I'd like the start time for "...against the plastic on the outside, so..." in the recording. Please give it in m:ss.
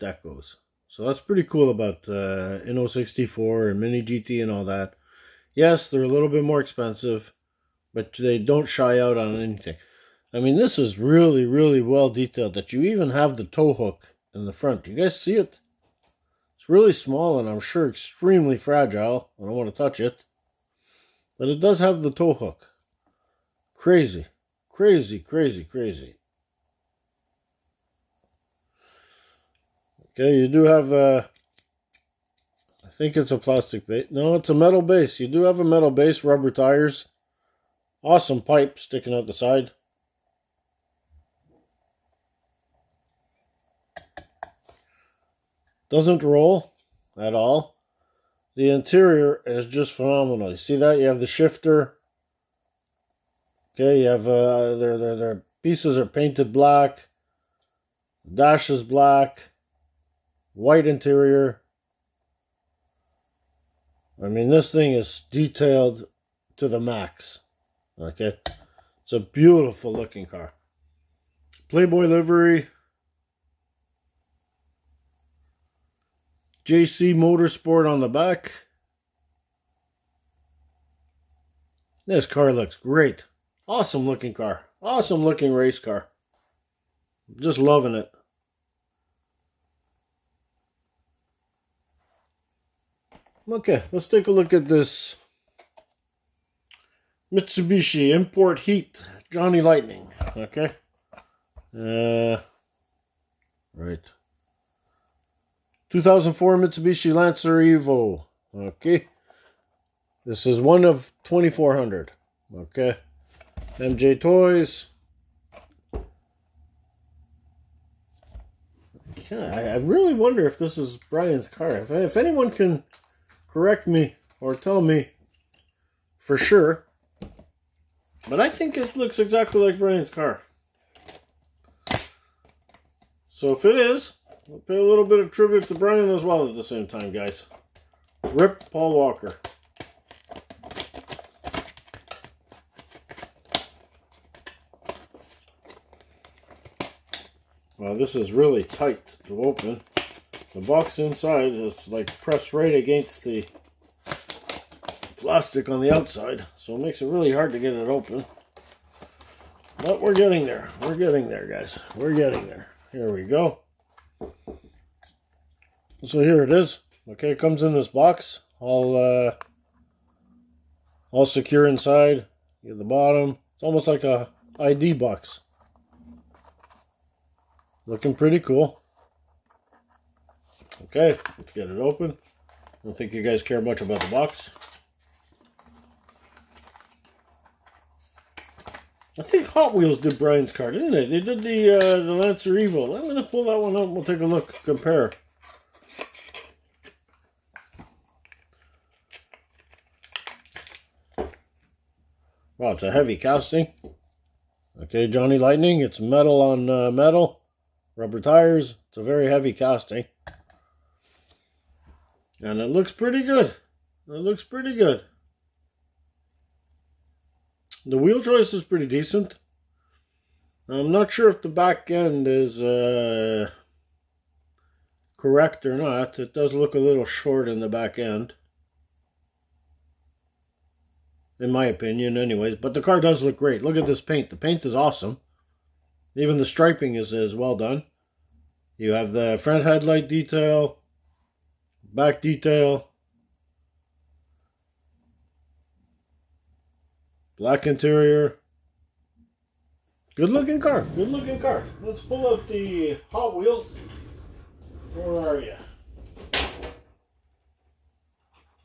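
2:32.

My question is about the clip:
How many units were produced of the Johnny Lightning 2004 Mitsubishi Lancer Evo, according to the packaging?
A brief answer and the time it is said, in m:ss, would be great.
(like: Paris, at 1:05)
2400, at 1:50.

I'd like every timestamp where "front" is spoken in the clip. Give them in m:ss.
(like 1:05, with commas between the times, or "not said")
0:14, 3:59.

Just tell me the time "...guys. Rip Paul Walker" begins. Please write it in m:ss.
2:17.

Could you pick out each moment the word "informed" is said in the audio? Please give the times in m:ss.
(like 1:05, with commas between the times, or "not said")
not said.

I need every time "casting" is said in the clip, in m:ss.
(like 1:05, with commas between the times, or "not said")
3:23, 3:29.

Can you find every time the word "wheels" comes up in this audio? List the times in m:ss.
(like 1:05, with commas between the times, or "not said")
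3:09, 3:37, 4:13.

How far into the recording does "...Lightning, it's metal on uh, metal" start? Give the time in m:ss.
3:25.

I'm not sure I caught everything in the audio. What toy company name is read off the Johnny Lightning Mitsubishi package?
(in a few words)
MiJo Toys.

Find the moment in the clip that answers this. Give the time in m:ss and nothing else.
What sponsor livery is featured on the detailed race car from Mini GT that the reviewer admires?
1:11.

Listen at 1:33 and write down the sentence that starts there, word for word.
Okay, let's take a look at this Mitsubishi Import Heat Johnny Lightning.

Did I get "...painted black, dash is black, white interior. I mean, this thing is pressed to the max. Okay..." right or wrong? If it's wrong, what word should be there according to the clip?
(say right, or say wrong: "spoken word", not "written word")
wrong: "detailed", not "pressed".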